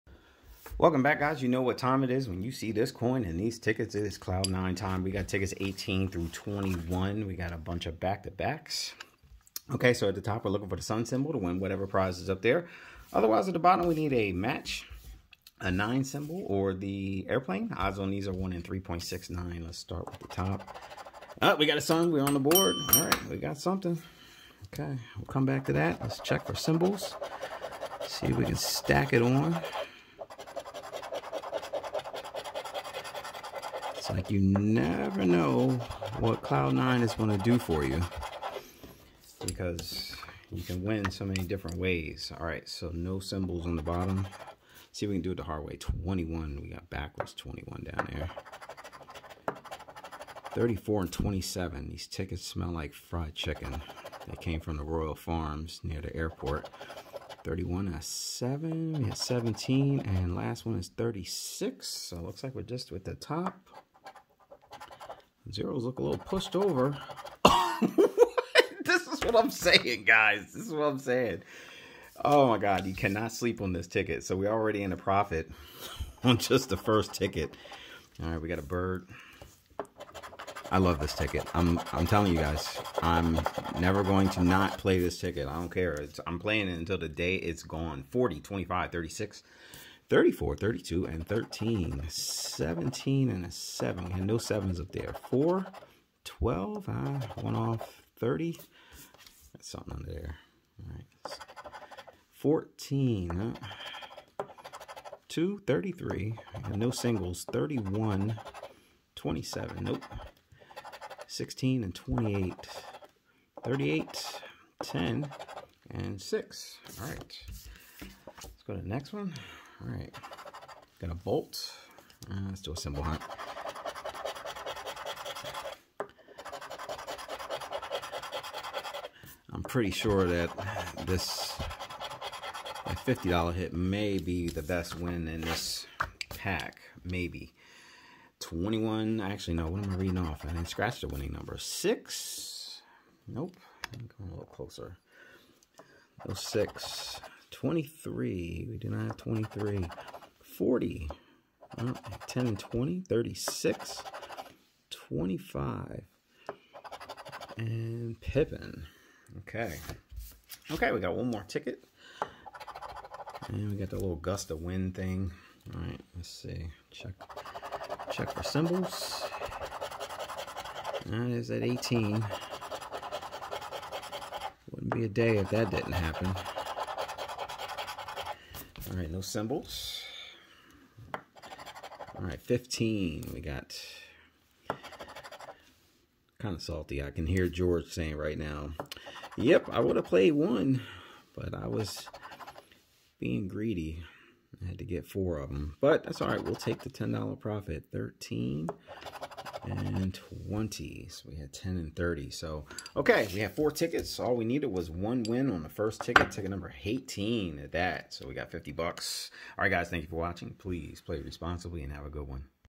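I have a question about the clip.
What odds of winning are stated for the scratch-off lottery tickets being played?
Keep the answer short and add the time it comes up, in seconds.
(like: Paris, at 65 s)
1 in 3.69, at 18 s.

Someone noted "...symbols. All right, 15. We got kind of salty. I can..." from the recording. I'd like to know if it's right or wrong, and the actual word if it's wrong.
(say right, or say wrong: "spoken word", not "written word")
right.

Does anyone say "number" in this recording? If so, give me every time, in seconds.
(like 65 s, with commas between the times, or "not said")
141 s, 206 s.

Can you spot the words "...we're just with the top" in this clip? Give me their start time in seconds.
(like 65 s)
62 s.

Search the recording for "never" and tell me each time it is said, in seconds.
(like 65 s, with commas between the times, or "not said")
34 s, 83 s.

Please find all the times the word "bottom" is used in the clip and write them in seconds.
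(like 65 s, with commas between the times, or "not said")
13 s, 43 s.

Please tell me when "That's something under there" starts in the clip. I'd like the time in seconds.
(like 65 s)
99 s.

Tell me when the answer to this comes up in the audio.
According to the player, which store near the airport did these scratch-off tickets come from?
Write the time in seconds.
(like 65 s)
54 s.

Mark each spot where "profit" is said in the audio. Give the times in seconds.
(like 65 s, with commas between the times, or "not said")
74 s, 197 s.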